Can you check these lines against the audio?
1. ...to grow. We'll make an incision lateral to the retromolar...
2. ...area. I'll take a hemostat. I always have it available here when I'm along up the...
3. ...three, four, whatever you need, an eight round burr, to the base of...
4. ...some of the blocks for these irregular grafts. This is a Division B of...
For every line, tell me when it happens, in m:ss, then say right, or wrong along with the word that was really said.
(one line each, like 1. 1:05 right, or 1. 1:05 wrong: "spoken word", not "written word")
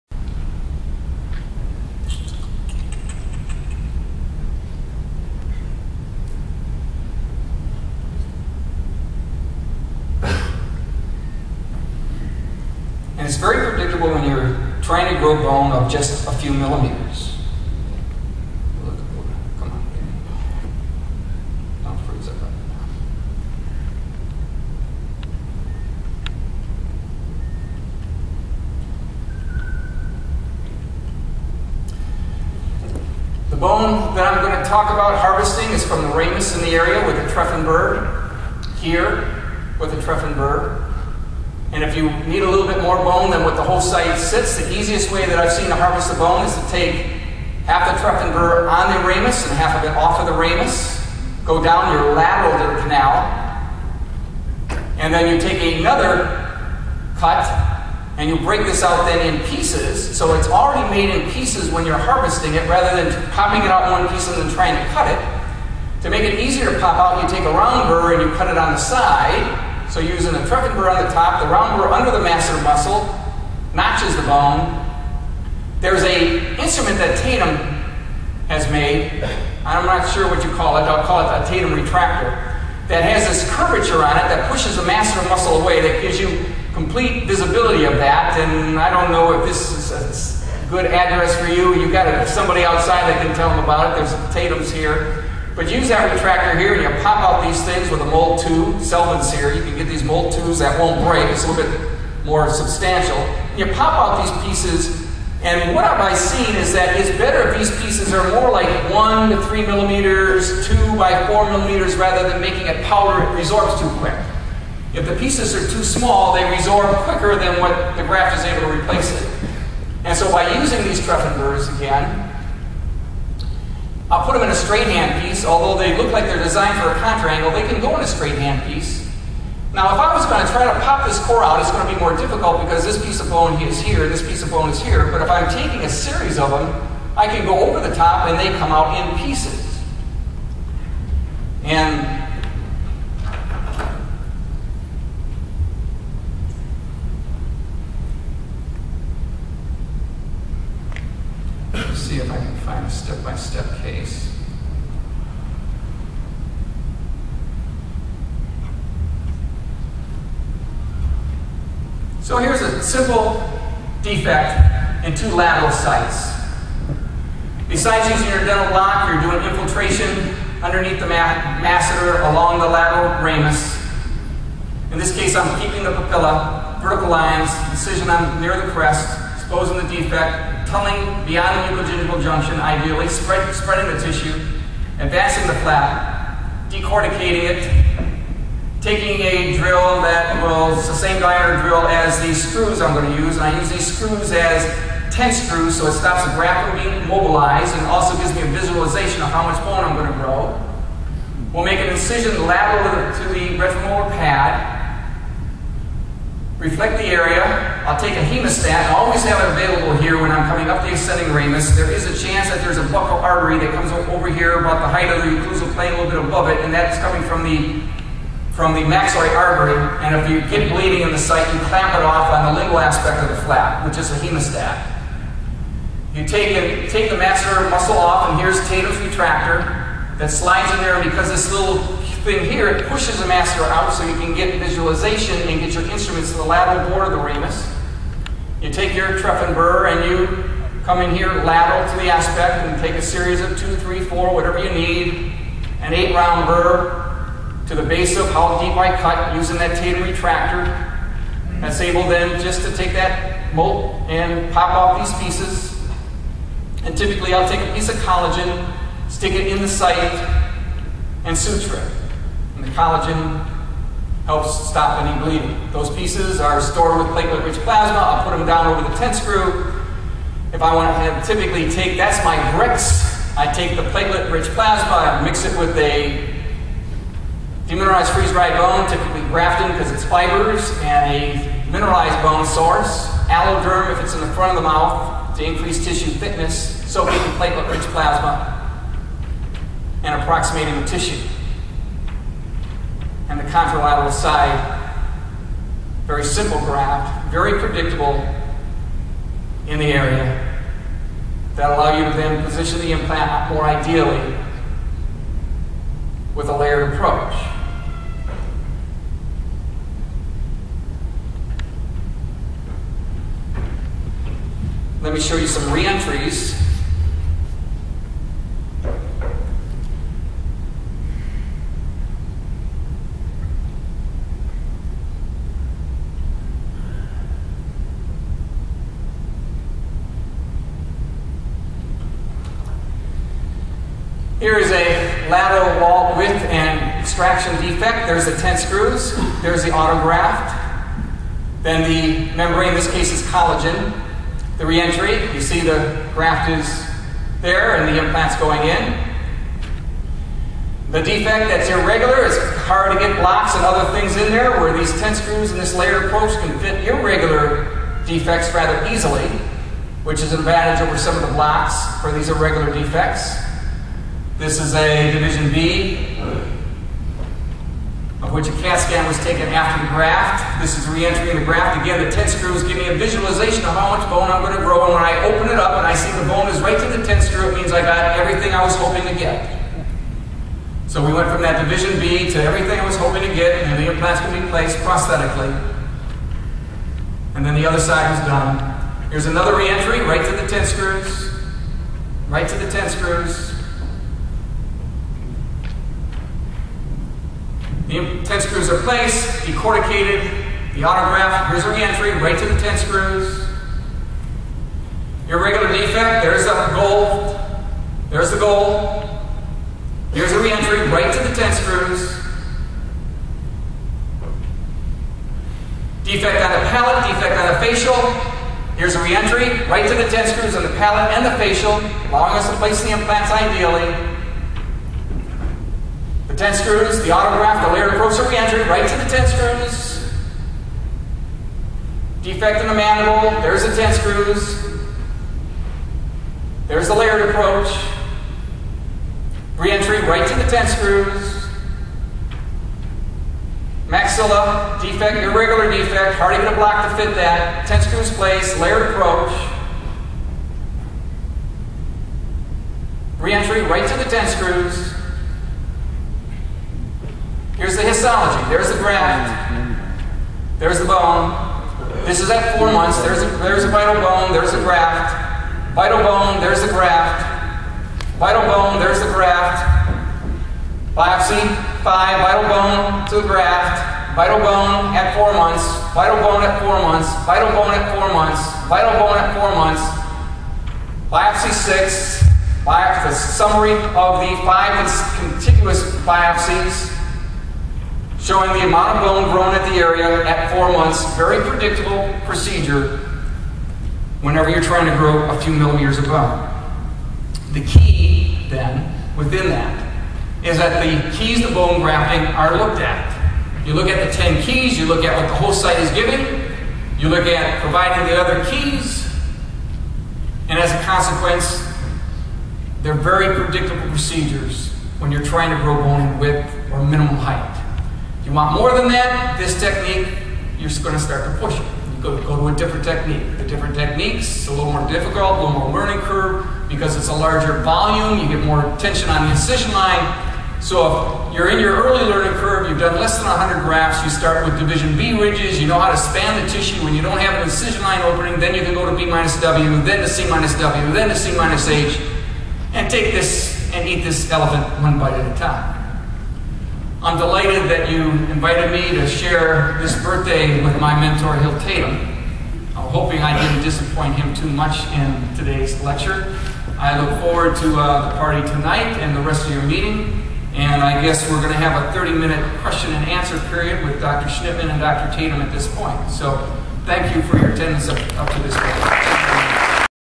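1. 3:20 right
2. 3:27 wrong: "coming", not "along"
3. 4:03 right
4. 6:00 wrong: "defects", not "grafts".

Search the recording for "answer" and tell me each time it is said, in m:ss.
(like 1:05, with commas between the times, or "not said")
9:23.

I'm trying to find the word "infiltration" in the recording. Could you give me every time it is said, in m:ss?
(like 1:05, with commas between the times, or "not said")
2:49.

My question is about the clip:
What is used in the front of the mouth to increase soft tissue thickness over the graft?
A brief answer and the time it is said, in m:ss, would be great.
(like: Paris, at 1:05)
Alloderm, at 4:43.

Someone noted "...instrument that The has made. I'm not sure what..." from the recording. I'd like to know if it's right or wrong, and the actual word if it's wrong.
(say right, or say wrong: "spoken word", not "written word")
wrong: "Tatum", not "The".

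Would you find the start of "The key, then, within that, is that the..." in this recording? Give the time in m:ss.
8:17.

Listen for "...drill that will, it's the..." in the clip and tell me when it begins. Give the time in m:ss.
3:09.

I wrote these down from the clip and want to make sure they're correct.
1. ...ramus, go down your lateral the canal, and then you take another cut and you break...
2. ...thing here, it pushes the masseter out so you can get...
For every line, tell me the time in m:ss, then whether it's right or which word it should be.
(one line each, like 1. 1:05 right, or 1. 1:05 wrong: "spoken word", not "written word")
1. 0:50 right
2. 3:52 right.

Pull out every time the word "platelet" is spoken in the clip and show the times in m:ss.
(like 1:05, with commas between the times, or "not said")
4:27, 4:33, 4:47.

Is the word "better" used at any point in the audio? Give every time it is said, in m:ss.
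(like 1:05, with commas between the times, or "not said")
1:47.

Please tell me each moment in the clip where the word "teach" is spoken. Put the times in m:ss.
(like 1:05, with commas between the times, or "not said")
not said.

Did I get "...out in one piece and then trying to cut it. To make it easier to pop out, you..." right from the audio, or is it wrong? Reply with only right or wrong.
right.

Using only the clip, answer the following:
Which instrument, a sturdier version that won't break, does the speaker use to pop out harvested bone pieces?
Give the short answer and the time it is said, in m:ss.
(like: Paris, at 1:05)
Molt, at 1:40.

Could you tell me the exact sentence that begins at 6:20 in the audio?
So we went from that division B to everything I was hoping to get, and the implants can be placed prosthetically.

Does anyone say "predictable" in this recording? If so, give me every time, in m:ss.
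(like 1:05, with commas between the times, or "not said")
4:57, 8:11, 8:33.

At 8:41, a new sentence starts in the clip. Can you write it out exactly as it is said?
You go, go to a different technique.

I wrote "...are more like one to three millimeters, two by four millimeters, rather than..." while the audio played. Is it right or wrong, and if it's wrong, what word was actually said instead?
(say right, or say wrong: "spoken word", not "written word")
right.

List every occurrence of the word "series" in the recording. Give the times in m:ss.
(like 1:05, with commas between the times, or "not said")
2:15, 4:03.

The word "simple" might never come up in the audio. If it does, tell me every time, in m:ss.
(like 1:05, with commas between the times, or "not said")
2:42, 4:56.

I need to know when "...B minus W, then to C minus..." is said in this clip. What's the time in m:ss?
8:58.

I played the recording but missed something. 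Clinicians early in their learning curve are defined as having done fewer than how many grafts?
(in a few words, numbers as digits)
100.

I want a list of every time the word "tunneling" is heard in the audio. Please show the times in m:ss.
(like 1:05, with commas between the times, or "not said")
3:00.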